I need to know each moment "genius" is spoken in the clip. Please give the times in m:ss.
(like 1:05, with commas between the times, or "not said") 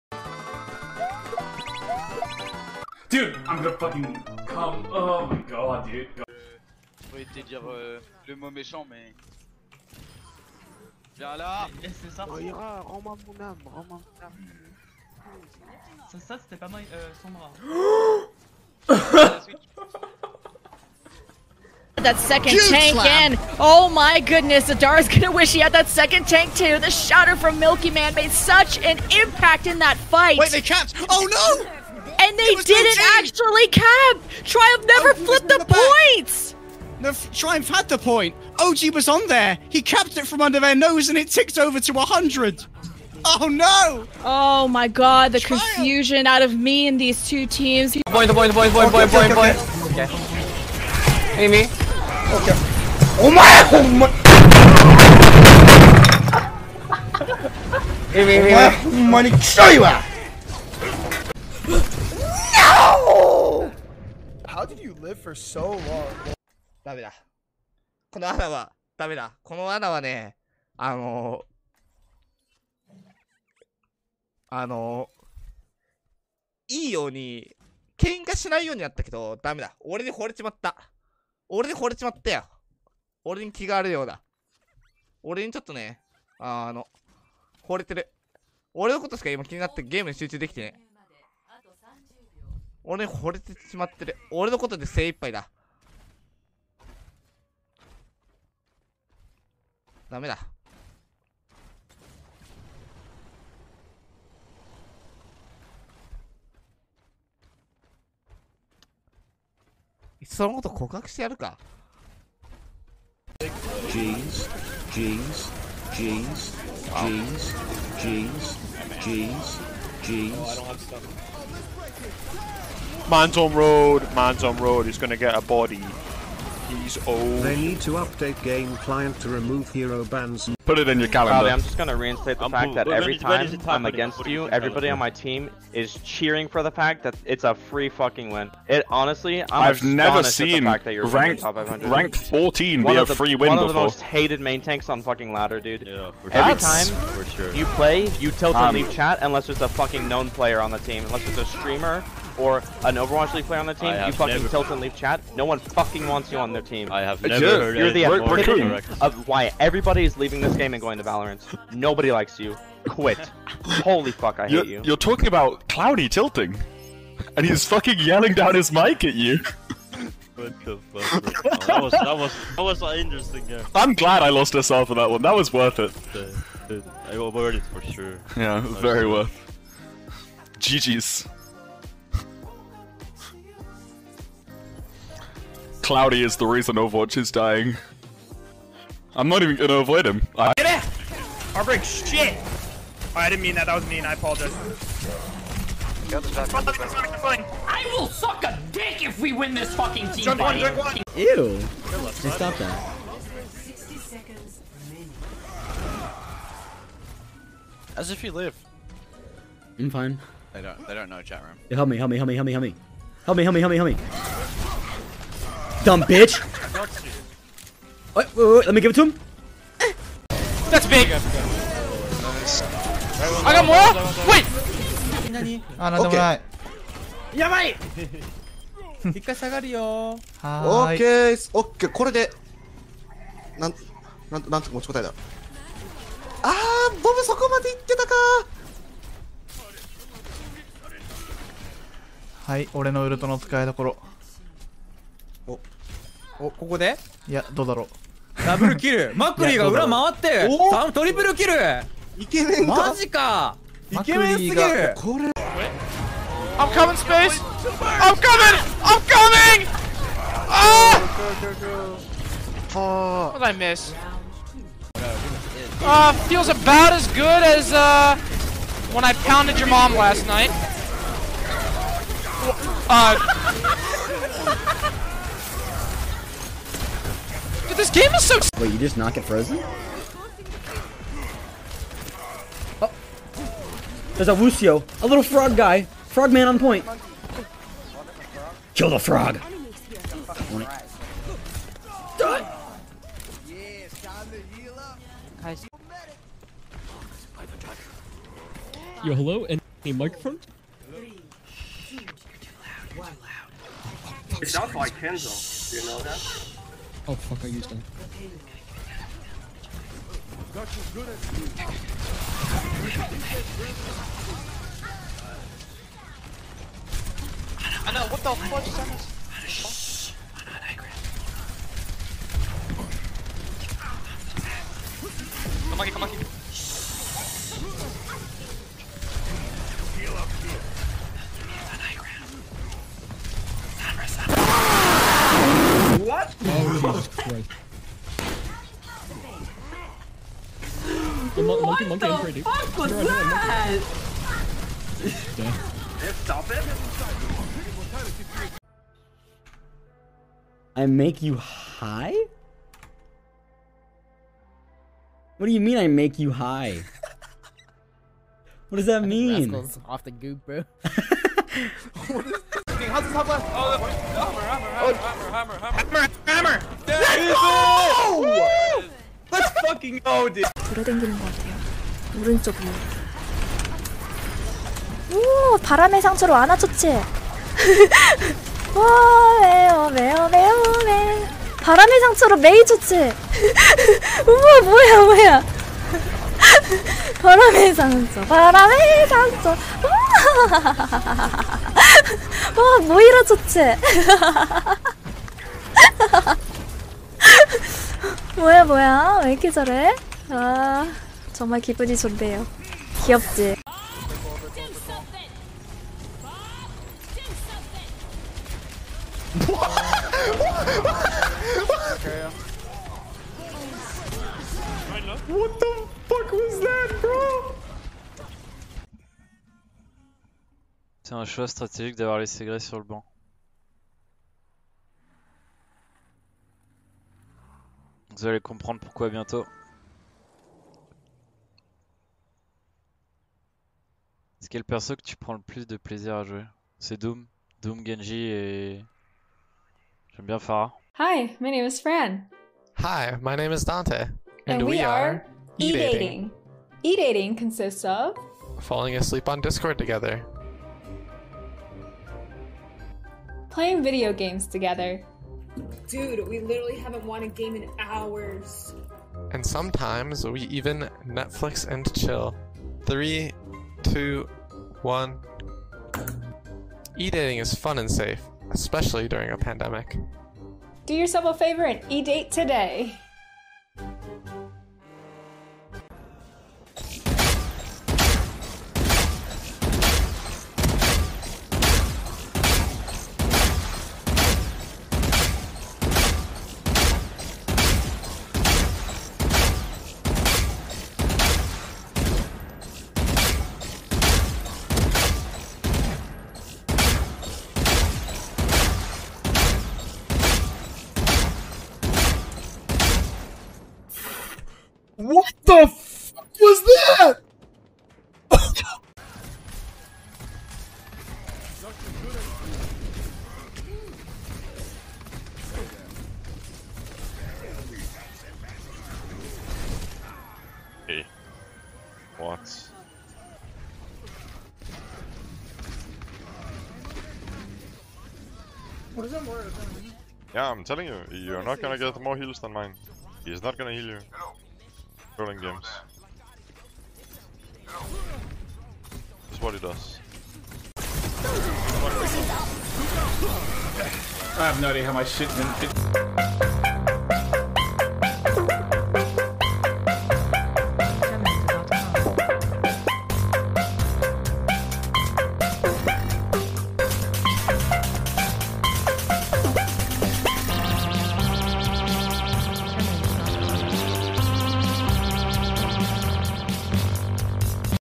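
not said.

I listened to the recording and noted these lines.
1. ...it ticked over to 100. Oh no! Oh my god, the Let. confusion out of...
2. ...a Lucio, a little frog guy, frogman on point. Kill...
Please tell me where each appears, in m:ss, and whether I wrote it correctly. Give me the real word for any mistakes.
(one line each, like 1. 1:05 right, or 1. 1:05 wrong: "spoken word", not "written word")
1. 0:41 wrong: "Triumph", not "Let"
2. 4:44 right.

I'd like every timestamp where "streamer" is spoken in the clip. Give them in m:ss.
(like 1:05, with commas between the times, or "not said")
2:31.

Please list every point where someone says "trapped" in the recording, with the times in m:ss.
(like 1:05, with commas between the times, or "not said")
0:30.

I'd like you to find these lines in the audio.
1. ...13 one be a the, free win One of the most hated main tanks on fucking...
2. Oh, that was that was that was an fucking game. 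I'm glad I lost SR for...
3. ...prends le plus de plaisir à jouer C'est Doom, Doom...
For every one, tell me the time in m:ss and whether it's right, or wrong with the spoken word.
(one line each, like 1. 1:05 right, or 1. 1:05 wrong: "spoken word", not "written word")
1. 2:22 wrong: "14", not "13"
2. 2:51 wrong: "interesting", not "fucking"
3. 7:15 right.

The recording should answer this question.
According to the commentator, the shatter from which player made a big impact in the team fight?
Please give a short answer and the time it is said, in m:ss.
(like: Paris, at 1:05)
Milky Man, at 0:27.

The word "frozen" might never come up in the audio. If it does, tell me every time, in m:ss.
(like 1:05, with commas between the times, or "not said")
4:39.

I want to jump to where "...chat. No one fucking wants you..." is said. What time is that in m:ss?
2:34.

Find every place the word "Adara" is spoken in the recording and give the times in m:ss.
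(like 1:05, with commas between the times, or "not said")
0:24.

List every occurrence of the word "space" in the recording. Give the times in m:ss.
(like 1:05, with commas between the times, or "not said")
4:16.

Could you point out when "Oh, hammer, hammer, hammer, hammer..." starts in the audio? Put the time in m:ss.
6:03.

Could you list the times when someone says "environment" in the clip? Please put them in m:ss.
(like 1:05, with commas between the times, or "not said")
not said.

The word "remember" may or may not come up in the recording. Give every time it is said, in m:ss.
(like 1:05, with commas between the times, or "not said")
not said.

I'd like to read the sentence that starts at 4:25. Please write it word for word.
Uh, feels about as good as uh, when I pounded your mom last night.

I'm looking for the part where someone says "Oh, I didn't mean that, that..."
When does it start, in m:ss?
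3:12.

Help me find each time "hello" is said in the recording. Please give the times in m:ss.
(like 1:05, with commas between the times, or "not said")
4:59.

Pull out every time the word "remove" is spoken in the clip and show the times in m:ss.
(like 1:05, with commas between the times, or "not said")
2:09.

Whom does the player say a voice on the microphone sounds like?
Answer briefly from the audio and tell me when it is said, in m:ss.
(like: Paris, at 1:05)
Kenzo, at 5:04.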